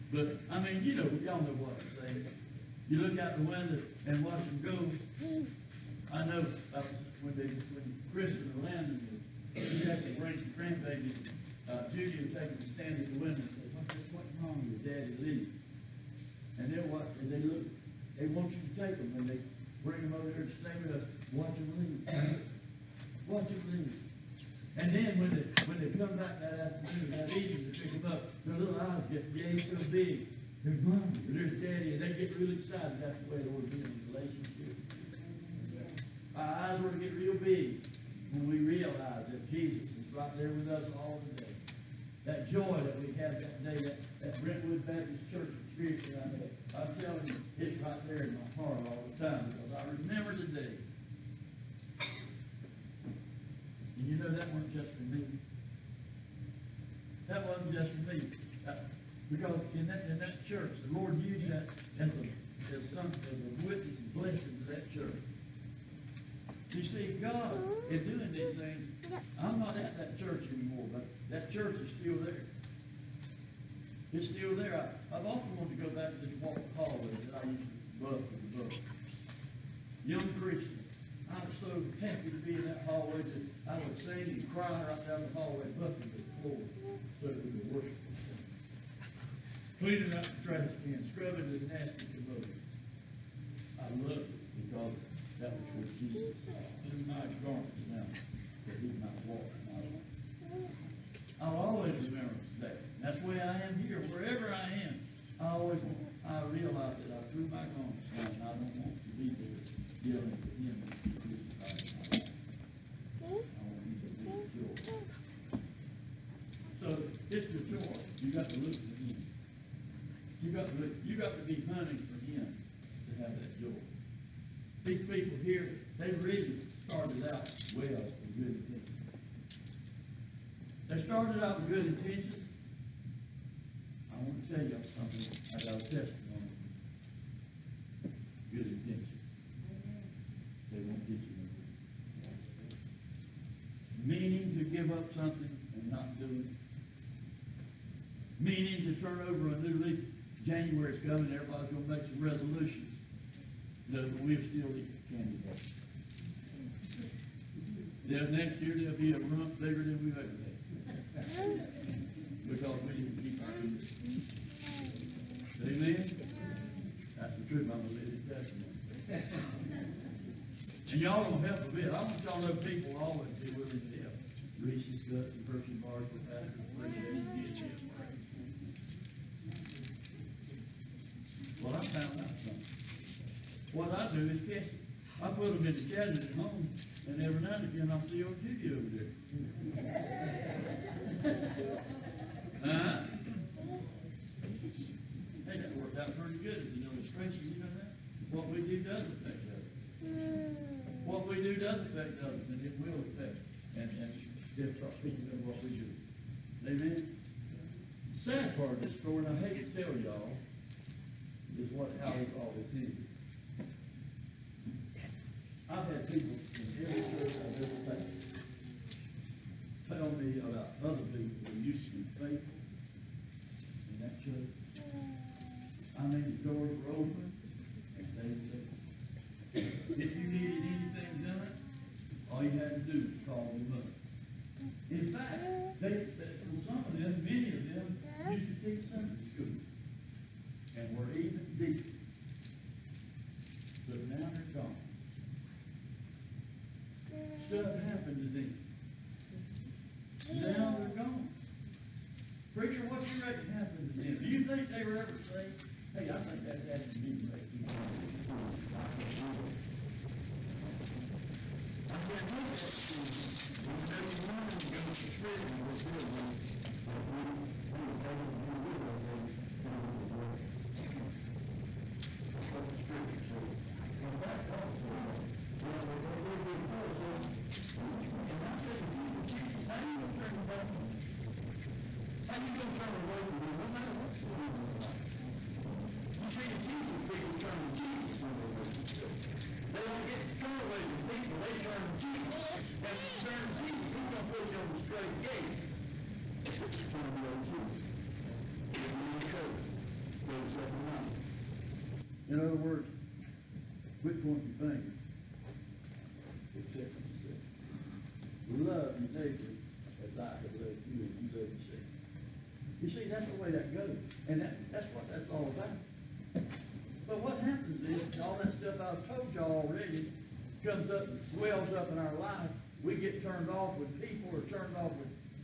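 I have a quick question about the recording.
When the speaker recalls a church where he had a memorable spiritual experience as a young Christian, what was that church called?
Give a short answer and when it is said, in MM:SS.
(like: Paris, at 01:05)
Brentwood Baptist Church, at 00:44.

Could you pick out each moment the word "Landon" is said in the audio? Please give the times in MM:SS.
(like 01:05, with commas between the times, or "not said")
00:08.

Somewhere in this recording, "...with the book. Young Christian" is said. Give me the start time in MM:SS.
01:18.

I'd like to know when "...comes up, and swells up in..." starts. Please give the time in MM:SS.
05:20.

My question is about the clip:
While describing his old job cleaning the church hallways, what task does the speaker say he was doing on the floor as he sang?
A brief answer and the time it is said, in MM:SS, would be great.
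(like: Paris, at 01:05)
Buffing the floor, at 01:25.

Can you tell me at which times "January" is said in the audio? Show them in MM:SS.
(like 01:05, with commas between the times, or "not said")
02:30.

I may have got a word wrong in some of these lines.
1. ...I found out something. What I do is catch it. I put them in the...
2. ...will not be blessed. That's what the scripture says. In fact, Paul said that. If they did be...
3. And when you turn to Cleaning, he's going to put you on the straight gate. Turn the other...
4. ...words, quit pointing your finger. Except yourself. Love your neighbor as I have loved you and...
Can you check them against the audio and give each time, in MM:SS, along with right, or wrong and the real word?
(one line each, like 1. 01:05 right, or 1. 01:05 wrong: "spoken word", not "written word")
1. 03:01 right
2. 04:29 right
3. 04:52 wrong: "Jesus", not "Cleaning"
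4. 05:02 right.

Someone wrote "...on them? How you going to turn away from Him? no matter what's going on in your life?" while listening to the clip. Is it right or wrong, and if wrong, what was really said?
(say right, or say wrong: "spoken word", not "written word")
right.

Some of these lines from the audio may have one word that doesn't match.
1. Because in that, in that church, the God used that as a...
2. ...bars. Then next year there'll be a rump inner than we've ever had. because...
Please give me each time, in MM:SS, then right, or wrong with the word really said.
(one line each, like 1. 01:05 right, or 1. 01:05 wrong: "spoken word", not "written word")
1. 00:59 wrong: "Lord", not "God"
2. 02:35 wrong: "bigger", not "inner".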